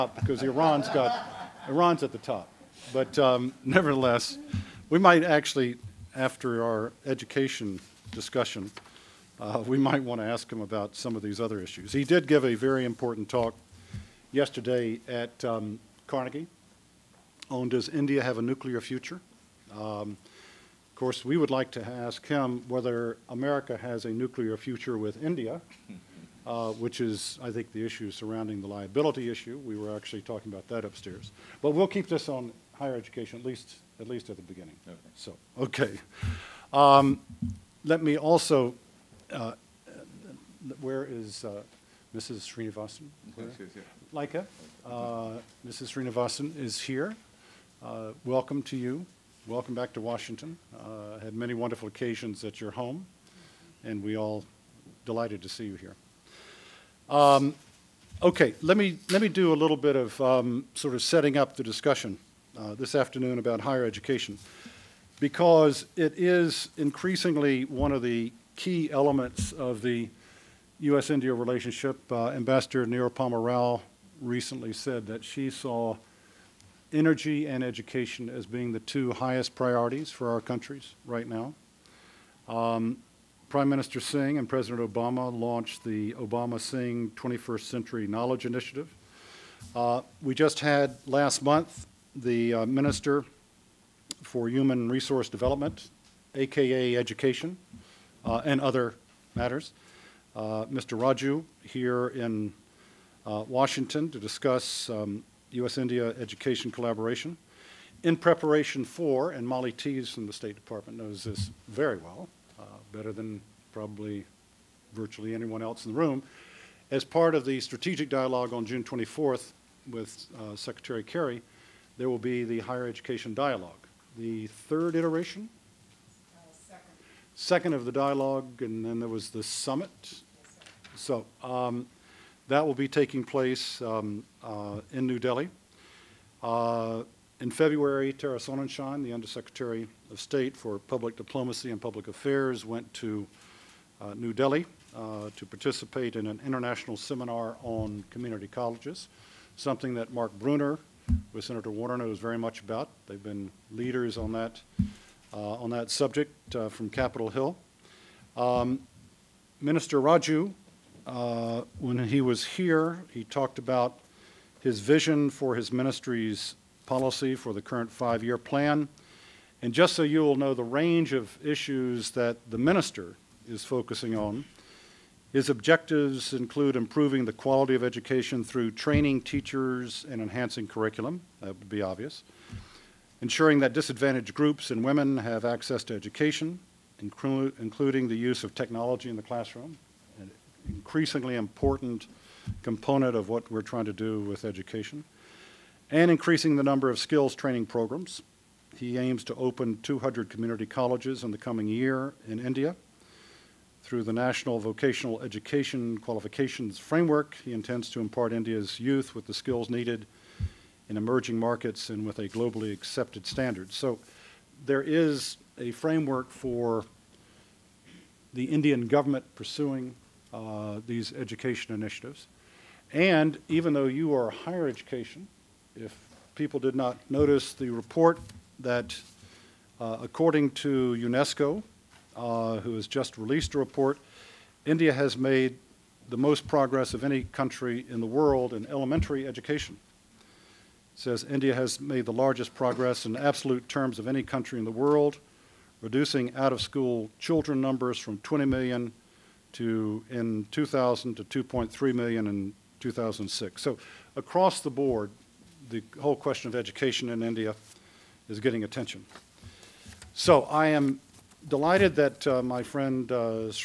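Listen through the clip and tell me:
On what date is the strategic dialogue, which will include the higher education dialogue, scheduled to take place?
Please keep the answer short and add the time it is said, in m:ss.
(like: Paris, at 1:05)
June 24th, at 1:58.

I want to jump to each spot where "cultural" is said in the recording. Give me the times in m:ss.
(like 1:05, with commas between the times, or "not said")
not said.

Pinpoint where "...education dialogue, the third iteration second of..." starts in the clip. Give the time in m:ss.
2:02.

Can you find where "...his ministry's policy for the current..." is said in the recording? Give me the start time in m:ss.
2:45.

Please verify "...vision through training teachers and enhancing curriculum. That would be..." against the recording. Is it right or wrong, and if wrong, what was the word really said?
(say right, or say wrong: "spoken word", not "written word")
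wrong: "education", not "vision".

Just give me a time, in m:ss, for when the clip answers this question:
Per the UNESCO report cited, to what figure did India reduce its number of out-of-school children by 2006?
4:11.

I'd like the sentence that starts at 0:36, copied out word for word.
Um, let me also, uh, where is, uh, Mrs.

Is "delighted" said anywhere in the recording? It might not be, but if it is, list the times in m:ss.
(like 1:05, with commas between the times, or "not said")
0:55, 4:21.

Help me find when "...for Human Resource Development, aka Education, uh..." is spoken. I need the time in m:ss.
1:34.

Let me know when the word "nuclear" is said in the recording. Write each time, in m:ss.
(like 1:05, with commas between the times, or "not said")
0:18, 0:24.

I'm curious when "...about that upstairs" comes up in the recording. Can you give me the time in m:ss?
0:30.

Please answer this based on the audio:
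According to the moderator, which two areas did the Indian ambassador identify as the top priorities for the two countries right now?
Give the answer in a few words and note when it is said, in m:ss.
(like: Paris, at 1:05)
energy and education, at 1:16.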